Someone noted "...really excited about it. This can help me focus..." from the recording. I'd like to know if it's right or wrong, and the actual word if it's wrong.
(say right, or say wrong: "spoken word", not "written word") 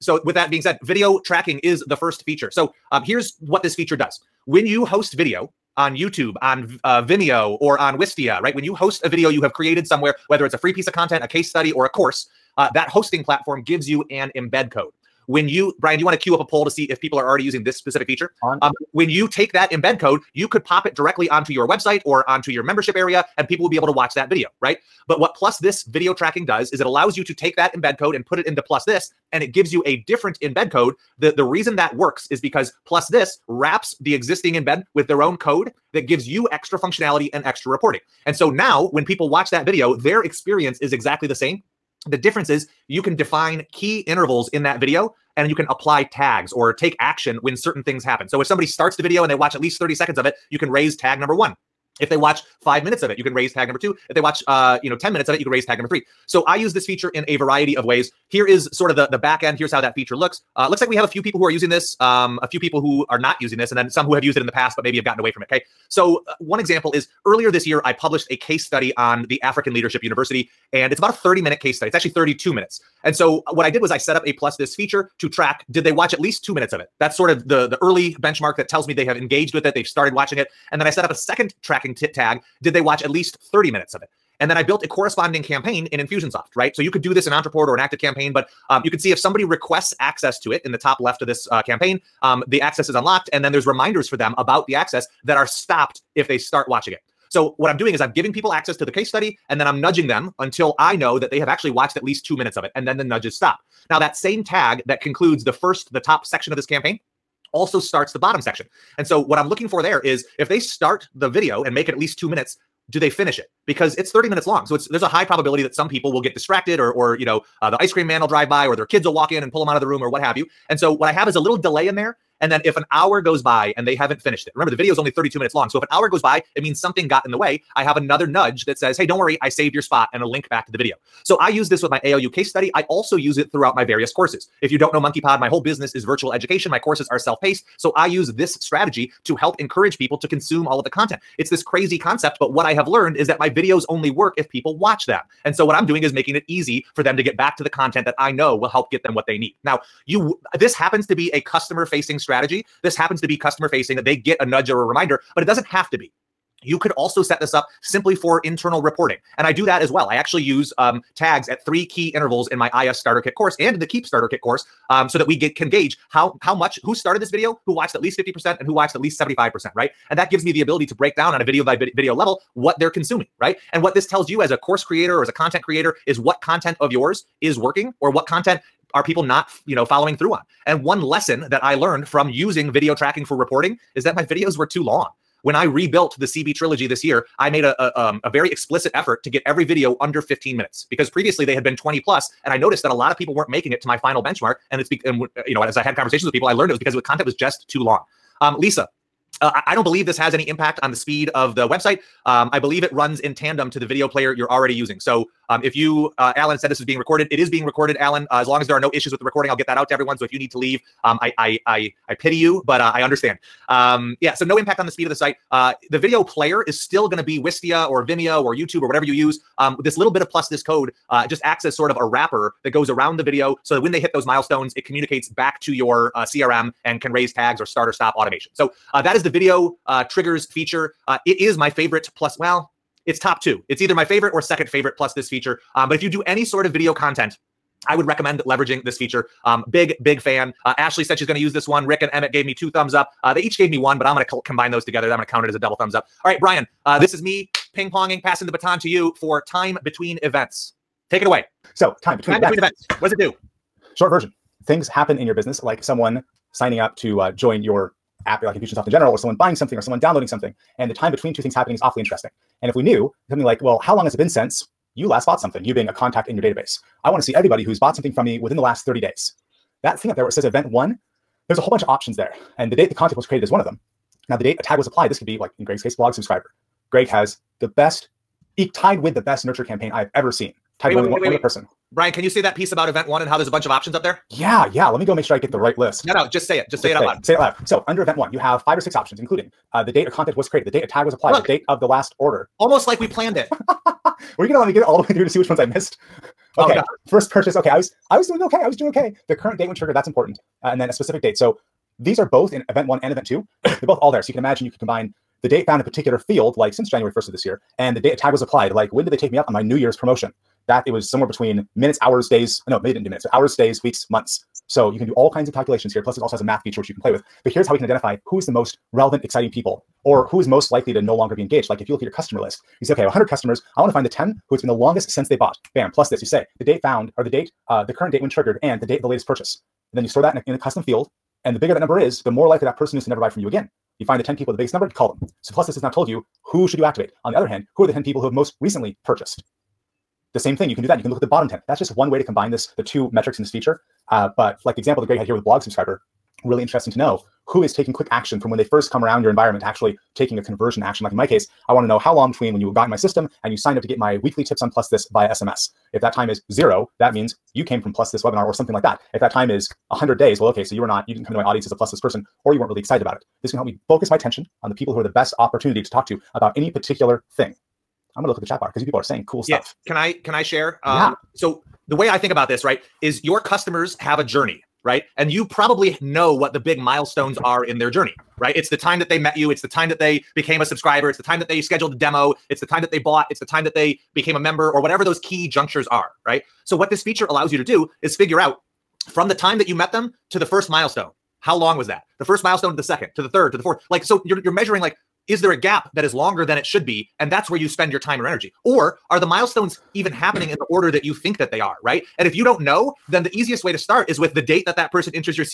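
right.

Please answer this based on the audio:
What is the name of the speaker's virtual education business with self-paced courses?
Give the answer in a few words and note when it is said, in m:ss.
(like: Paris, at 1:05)
MonkeyPod, at 2:14.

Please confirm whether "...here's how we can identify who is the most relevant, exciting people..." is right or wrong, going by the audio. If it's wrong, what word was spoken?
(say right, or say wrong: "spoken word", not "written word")
right.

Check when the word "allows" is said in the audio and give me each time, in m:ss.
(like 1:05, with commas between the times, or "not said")
0:26, 6:27.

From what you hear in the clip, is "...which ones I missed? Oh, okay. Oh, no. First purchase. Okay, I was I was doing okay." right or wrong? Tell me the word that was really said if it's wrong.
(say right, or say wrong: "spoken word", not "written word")
right.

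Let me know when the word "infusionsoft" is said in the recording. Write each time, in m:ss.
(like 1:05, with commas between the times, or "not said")
1:25, 4:18.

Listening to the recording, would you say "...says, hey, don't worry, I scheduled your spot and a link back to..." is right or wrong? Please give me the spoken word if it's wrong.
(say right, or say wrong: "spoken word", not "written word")
wrong: "saved", not "scheduled".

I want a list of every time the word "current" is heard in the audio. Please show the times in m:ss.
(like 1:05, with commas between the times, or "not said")
4:59, 5:27.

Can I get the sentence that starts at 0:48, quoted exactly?
So if somebody starts the video and they watch at least 30 seconds of it, you can raise tag number one.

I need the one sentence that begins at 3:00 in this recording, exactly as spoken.
And one lesson that I learned from using video tracking for reporting is that my videos were too long.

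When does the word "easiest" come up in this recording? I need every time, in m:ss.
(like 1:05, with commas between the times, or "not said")
6:43.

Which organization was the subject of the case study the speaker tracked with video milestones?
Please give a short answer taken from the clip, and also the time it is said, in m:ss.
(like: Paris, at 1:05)
African Leadership University, at 1:09.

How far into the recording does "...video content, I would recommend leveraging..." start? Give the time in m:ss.
3:56.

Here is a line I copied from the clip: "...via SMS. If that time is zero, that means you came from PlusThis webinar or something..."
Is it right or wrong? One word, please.
right.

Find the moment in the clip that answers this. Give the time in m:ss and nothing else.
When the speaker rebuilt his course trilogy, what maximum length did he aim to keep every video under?
3:10.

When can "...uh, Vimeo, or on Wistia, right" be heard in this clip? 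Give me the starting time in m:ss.
0:06.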